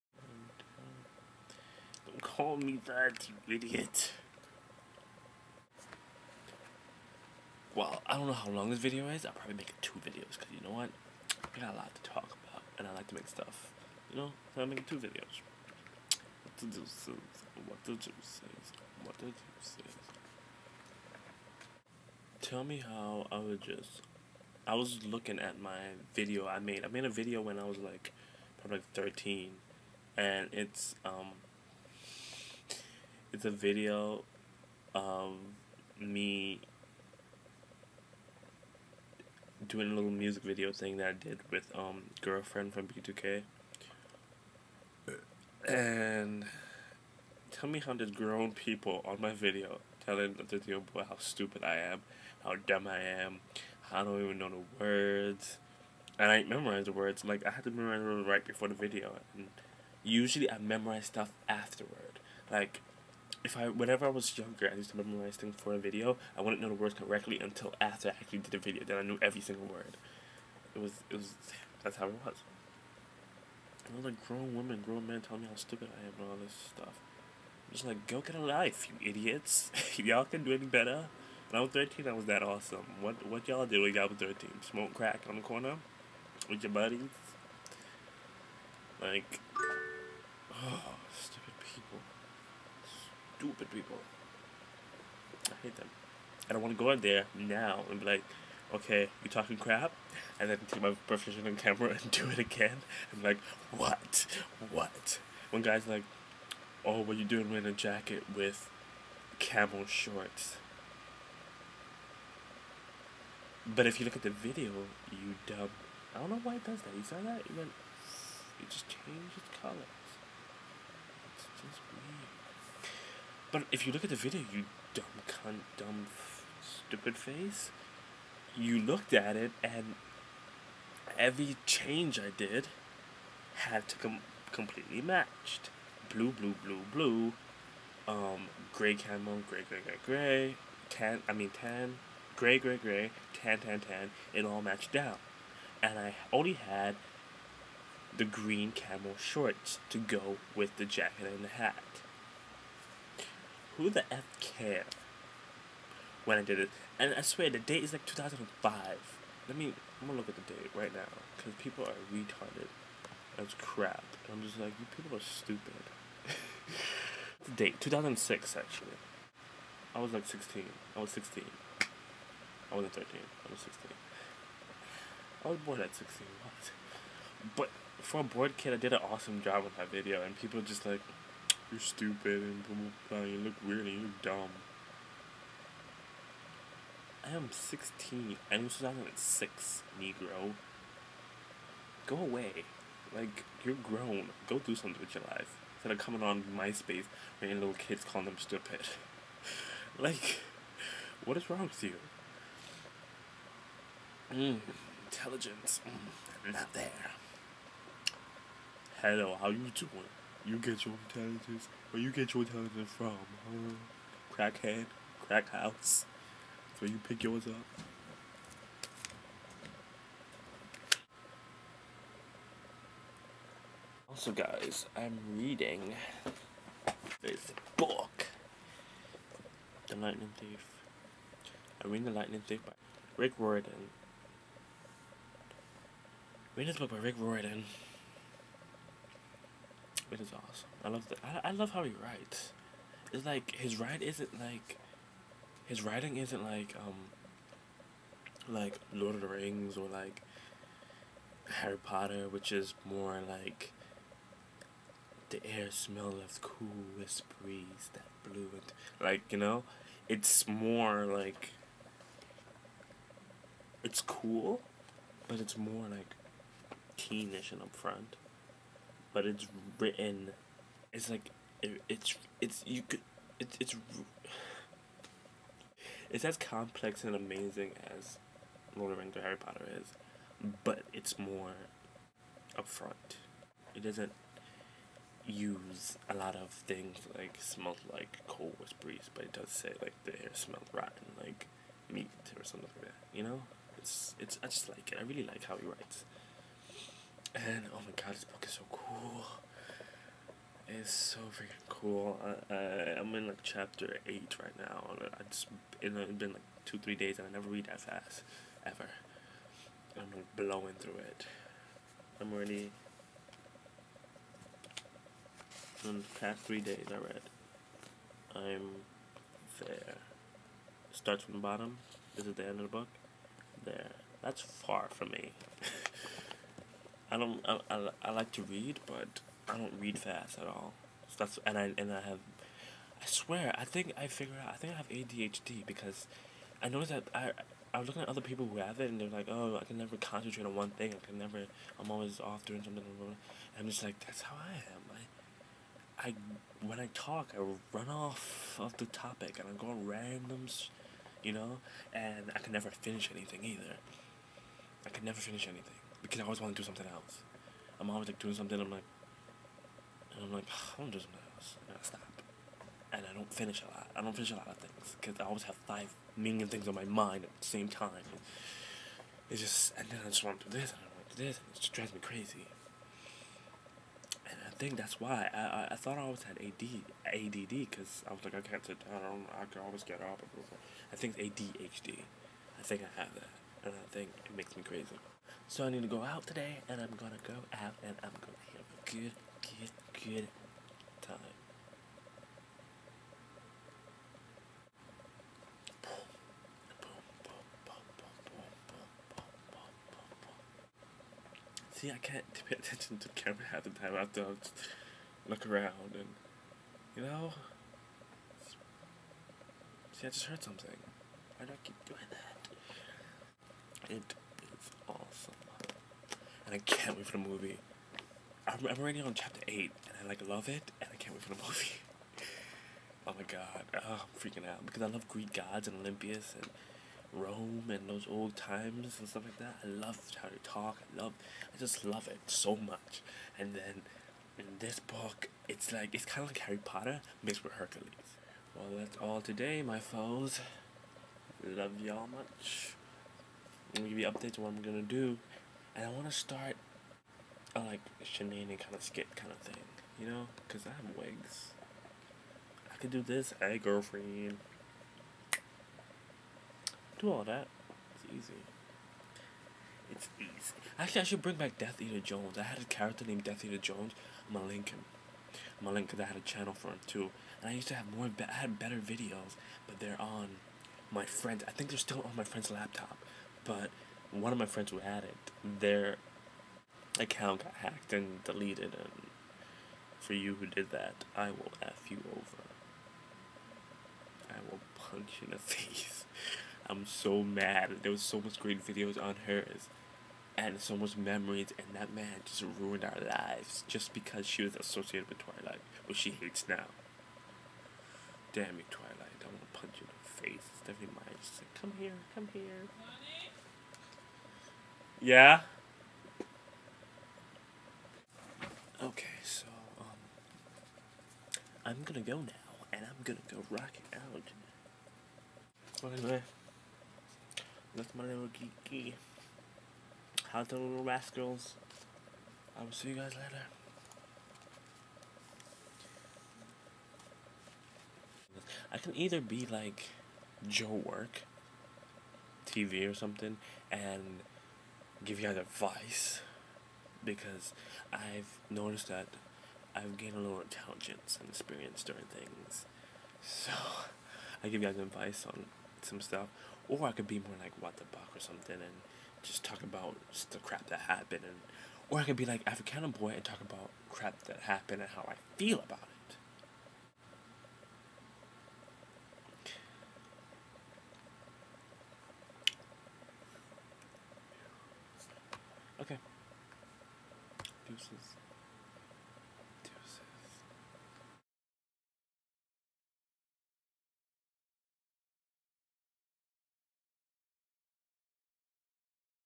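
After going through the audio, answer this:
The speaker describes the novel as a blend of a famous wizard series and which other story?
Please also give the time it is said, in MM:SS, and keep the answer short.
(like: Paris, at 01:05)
Hercules, at 07:17.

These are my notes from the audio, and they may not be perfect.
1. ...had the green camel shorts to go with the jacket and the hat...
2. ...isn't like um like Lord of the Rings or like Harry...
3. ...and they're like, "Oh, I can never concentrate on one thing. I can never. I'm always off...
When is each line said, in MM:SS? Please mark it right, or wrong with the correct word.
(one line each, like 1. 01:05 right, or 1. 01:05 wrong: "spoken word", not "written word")
1. 02:26 right
2. 04:06 right
3. 05:38 right.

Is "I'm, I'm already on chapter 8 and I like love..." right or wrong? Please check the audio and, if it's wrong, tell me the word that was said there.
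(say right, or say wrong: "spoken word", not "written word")
right.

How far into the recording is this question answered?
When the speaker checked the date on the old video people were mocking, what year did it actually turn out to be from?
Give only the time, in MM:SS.
02:47.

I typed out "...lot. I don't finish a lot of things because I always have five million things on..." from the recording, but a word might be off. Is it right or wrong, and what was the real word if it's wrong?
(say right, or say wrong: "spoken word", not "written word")
right.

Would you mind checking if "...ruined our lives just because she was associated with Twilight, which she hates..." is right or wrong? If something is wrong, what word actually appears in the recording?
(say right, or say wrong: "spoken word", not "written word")
right.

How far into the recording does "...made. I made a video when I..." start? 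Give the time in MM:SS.
00:26.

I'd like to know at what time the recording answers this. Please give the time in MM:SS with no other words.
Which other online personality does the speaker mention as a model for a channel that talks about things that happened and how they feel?
09:12.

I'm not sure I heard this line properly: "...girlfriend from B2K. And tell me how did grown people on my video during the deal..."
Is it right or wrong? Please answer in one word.
wrong.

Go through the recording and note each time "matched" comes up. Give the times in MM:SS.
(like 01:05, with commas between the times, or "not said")
02:15, 02:24.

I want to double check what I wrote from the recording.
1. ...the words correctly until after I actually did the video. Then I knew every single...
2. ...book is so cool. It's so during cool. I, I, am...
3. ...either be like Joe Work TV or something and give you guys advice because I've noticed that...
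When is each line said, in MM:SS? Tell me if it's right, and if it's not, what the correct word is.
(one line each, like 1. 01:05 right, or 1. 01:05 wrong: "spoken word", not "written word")
1. 01:06 right
2. 04:58 wrong: "freaking", not "during"
3. 08:48 right.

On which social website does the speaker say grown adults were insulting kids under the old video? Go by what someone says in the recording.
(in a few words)
MySpace.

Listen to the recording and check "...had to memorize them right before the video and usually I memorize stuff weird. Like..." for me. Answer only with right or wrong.
wrong.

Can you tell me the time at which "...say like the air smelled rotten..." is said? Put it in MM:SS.
04:49.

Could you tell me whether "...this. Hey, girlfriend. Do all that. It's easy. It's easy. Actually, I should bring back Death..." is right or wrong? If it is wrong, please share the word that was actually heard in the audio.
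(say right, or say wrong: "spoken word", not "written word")
right.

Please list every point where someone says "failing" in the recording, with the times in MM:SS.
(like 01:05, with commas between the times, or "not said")
not said.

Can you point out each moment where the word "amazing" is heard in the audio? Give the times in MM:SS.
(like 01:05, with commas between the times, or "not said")
04:37.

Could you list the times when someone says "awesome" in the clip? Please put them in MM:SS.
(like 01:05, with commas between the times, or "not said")
01:22, 02:59, 04:00, 06:55.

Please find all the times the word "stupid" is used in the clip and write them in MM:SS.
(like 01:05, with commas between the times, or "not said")
00:51, 01:15, 01:33, 02:06, 02:45, 03:01, 03:18.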